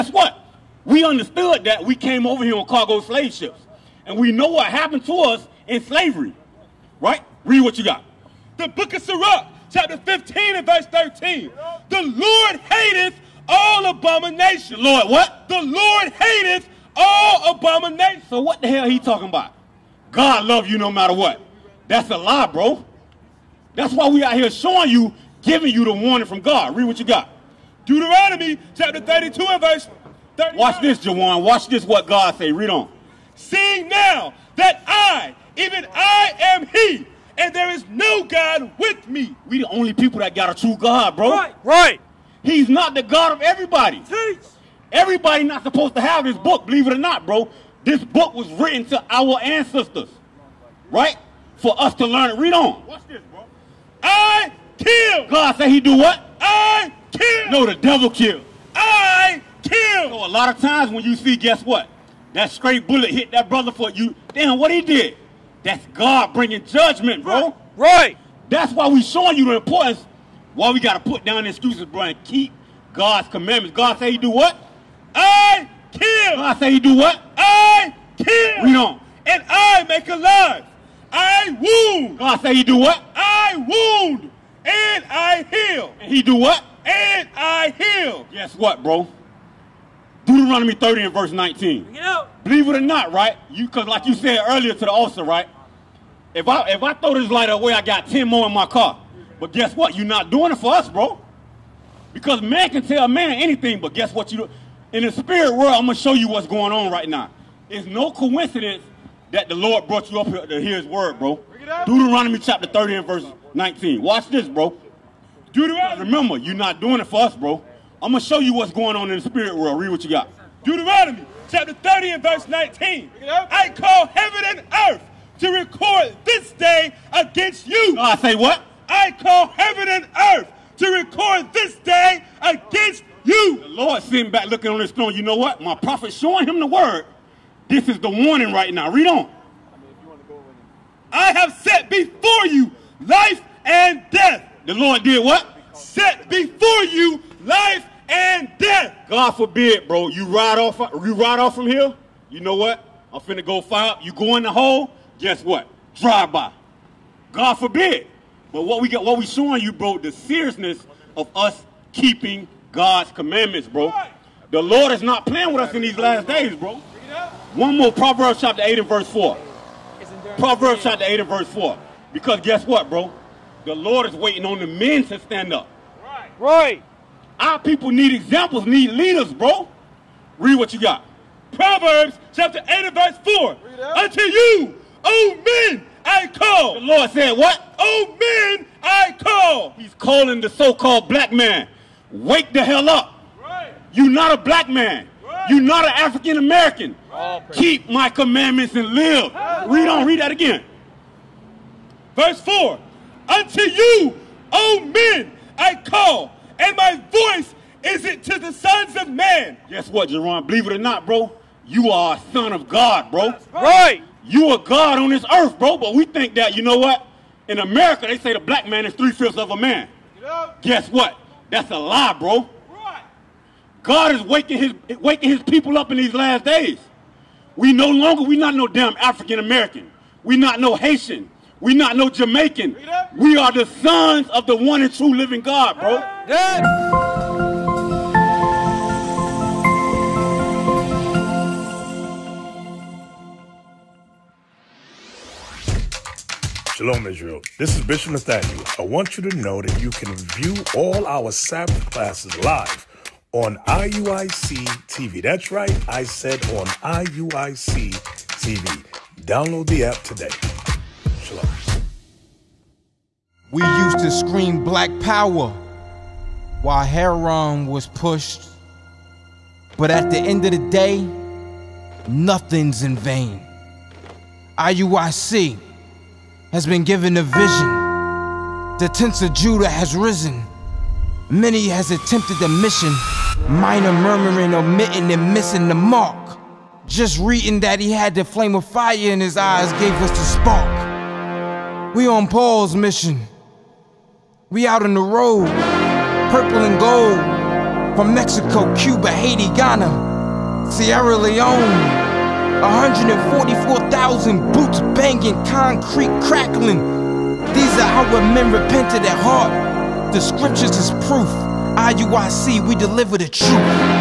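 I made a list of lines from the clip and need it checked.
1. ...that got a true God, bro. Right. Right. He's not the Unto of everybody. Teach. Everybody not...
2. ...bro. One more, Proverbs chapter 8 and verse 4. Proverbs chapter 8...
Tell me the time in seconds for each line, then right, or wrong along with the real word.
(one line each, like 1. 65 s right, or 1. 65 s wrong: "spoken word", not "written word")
1. 40 s wrong: "God", not "Unto"
2. 166 s right.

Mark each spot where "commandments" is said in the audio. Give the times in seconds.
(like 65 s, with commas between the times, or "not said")
73 s, 163 s, 198 s.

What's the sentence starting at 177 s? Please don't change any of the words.
Our people need examples, need leaders, bro.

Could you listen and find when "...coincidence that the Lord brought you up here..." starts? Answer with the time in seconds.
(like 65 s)
108 s.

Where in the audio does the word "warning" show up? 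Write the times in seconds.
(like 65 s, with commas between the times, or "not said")
25 s, 138 s.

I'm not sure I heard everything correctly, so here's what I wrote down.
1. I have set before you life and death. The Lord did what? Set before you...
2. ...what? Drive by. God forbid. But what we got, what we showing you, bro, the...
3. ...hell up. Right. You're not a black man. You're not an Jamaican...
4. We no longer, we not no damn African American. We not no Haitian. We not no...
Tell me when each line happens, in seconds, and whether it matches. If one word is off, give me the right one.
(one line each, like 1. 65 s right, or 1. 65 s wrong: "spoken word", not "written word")
1. 141 s right
2. 155 s right
3. 192 s wrong: "African", not "Jamaican"
4. 227 s right.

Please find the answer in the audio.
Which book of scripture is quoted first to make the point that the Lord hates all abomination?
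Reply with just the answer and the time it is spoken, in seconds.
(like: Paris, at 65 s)
Sirach, at 9 s.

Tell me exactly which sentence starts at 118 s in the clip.
I'm going to show you what's going on in the spirit world.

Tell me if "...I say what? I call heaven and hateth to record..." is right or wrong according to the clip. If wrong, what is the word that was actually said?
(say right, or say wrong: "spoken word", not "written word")
wrong: "earth", not "hateth".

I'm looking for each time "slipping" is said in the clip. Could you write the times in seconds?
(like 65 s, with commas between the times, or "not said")
not said.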